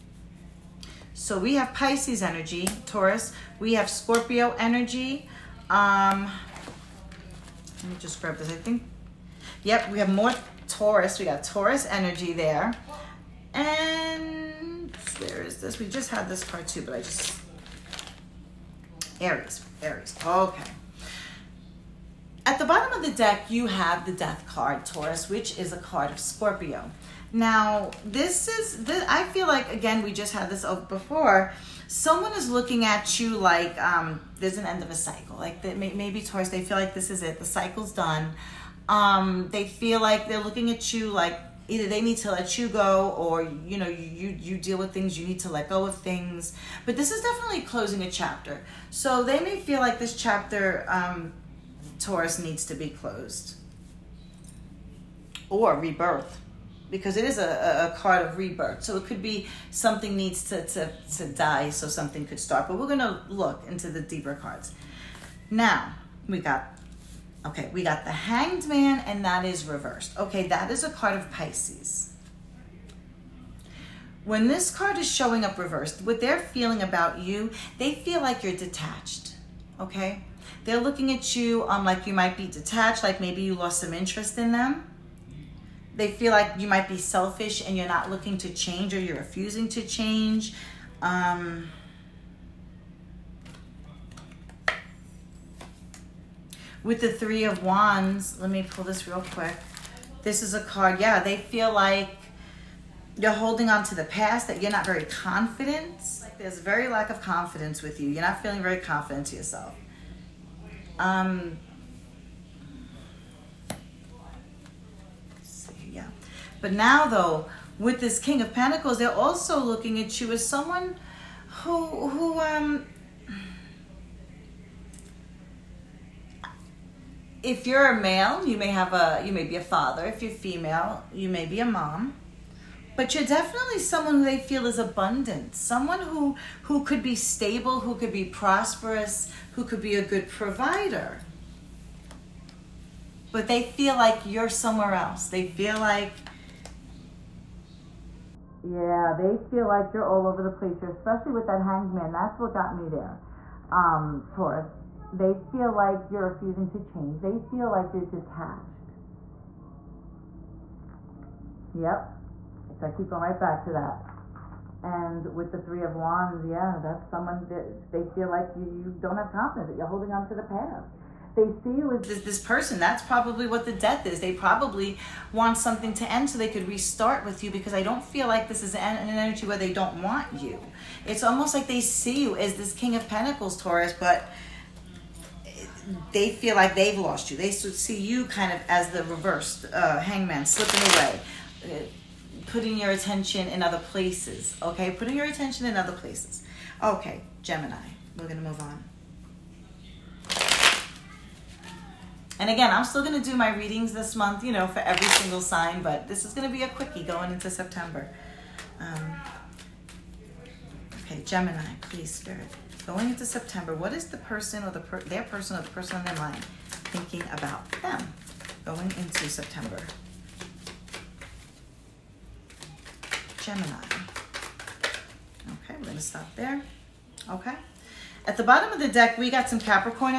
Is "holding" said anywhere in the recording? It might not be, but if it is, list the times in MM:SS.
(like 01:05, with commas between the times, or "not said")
01:43, 02:49.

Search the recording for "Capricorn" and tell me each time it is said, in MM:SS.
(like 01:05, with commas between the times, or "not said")
03:49.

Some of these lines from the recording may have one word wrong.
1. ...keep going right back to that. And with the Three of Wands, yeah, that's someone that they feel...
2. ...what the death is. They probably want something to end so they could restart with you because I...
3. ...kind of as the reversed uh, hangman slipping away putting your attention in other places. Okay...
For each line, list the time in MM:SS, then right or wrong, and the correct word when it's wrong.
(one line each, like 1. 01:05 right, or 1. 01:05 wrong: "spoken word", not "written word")
1. 02:42 right
2. 02:53 right
3. 03:08 right.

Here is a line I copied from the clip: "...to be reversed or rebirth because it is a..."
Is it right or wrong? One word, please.
wrong.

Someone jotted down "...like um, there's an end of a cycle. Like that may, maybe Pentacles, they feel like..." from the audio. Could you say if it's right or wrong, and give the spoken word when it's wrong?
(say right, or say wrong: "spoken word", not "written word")
wrong: "Taurus", not "Pentacles".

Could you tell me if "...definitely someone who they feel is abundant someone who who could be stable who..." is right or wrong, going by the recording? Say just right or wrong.
right.